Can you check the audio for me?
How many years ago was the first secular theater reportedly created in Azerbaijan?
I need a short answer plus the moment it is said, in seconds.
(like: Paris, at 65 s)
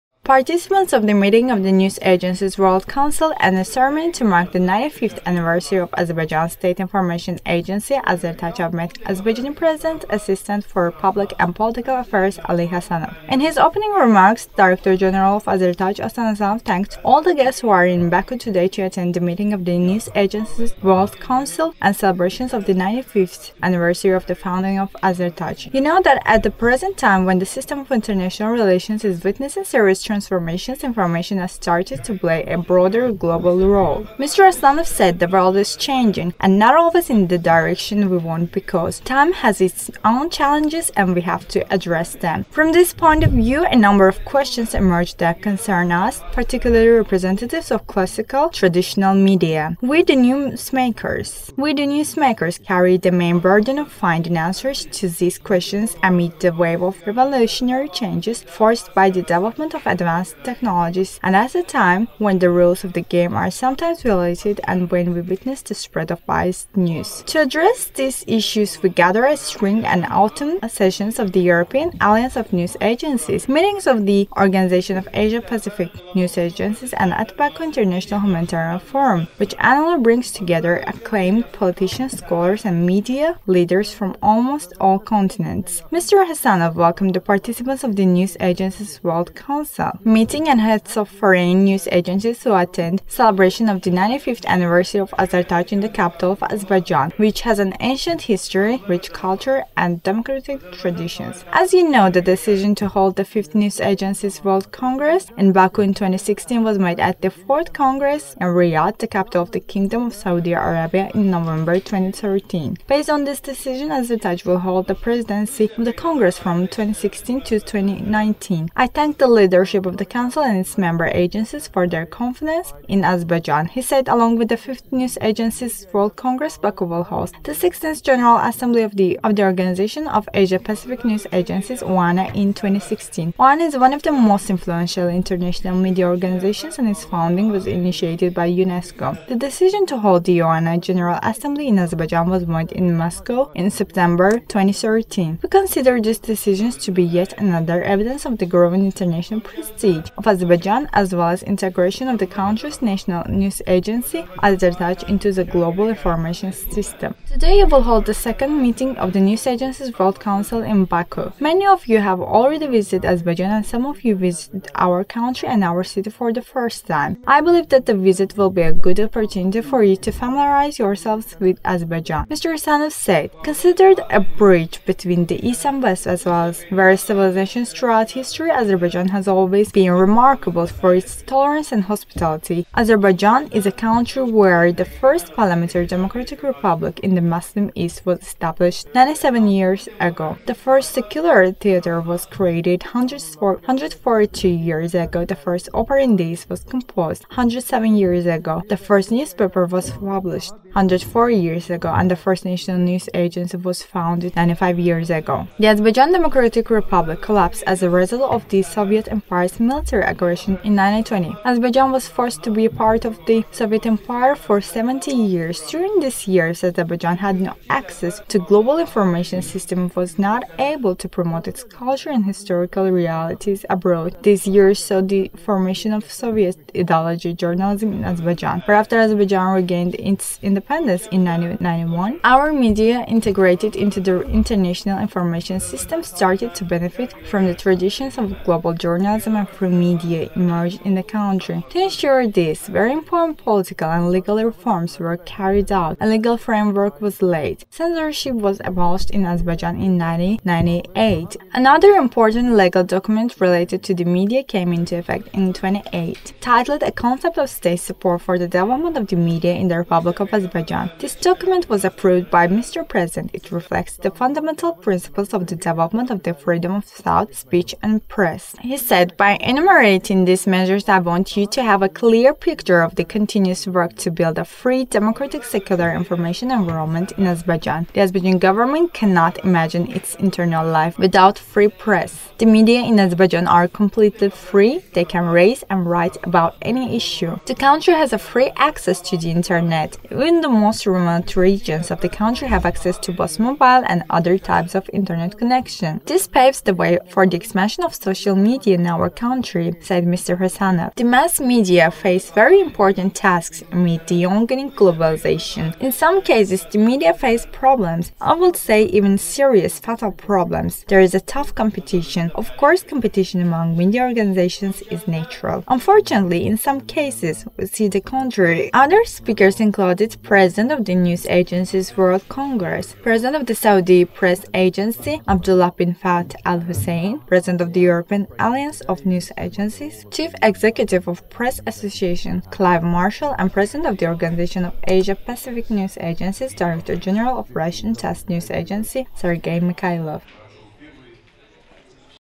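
142, at 192 s.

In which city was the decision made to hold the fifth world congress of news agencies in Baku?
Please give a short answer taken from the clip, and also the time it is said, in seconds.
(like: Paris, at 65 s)
Riyadh, at 108 s.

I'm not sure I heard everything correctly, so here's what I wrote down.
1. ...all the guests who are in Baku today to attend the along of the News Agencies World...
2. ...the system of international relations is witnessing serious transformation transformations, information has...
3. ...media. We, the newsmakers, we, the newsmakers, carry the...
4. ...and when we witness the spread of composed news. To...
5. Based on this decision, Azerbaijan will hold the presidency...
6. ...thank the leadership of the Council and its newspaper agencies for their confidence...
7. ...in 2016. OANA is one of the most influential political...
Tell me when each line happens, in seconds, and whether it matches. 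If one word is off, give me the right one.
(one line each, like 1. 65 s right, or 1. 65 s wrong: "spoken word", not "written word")
1. 17 s wrong: "meeting", not "along"
2. 27 s right
3. 49 s right
4. 64 s wrong: "biased", not "composed"
5. 112 s right
6. 118 s wrong: "member", not "newspaper"
7. 132 s wrong: "international", not "political".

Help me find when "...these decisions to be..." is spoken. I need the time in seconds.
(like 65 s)
146 s.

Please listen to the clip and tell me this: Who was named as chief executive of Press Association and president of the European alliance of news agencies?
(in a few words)
Clive Marshall.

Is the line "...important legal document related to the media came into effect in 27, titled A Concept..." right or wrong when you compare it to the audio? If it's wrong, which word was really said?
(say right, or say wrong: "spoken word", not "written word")
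wrong: "28", not "27".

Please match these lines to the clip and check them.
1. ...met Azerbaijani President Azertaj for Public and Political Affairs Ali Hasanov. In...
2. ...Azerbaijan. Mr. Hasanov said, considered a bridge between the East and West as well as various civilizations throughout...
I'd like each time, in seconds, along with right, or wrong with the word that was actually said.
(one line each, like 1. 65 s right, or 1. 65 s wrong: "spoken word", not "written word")
1. 8 s wrong: "Assistant", not "Azertaj"
2. 171 s right.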